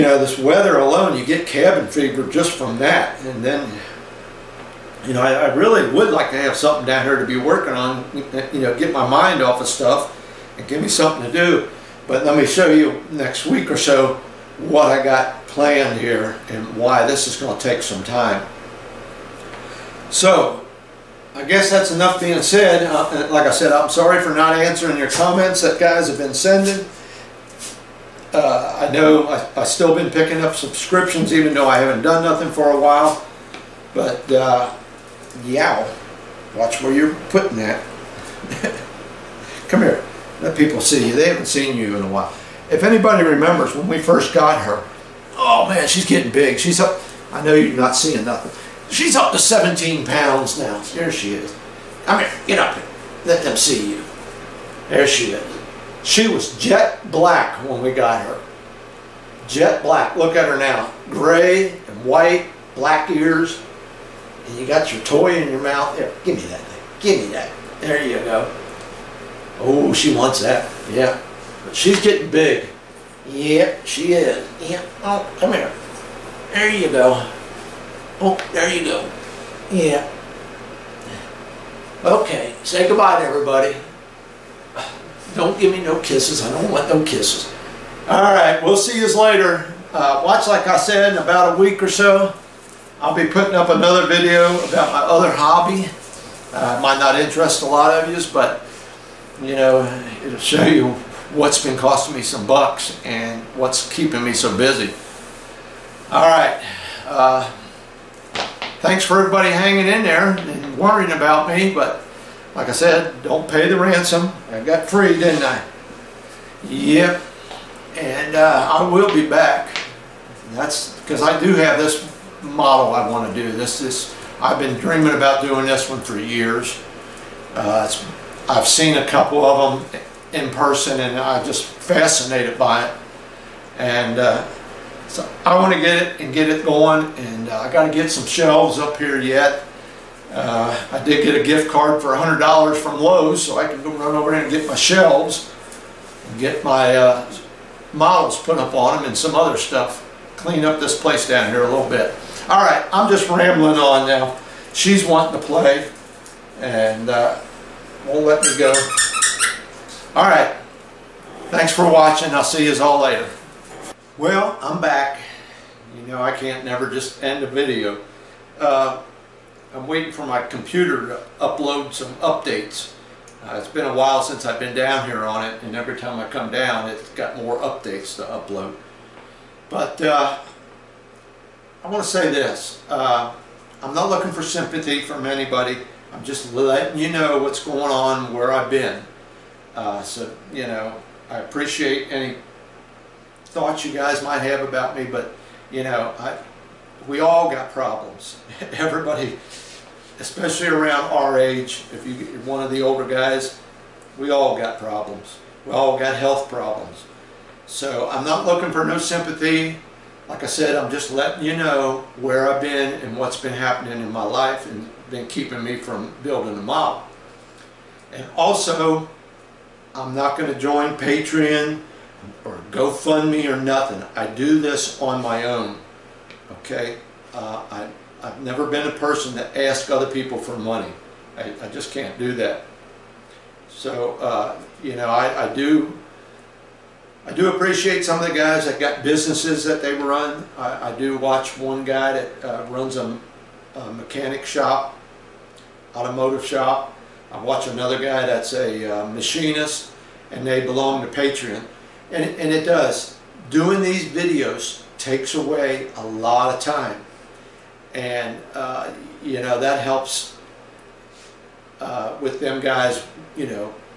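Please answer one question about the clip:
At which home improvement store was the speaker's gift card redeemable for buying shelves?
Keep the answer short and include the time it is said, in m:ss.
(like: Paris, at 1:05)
Lowe's, at 2:23.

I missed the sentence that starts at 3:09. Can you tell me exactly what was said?
Uh, so, you know, I appreciate any thoughts you guys might have about me, but you know, I, we all got problems.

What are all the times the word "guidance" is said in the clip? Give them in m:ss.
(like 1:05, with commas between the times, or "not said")
not said.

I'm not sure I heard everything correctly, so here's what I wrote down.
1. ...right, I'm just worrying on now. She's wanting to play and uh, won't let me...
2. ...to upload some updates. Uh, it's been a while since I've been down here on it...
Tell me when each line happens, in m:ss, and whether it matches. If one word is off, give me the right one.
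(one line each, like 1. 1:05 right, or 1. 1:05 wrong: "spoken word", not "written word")
1. 2:32 wrong: "rambling", not "worrying"
2. 2:51 right.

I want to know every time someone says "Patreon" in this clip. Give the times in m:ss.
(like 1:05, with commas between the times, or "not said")
3:40, 4:11.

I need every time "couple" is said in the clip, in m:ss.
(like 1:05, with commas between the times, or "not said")
2:09.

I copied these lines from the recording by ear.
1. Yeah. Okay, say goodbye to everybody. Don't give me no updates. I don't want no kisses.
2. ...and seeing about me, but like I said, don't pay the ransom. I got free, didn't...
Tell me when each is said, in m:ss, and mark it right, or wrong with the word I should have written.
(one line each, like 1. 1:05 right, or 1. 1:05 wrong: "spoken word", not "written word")
1. 1:19 wrong: "kisses", not "updates"
2. 1:50 wrong: "worrying", not "seeing".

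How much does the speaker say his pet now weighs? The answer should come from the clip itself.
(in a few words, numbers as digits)
17 pounds.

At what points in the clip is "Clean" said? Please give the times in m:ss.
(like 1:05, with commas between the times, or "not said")
2:30.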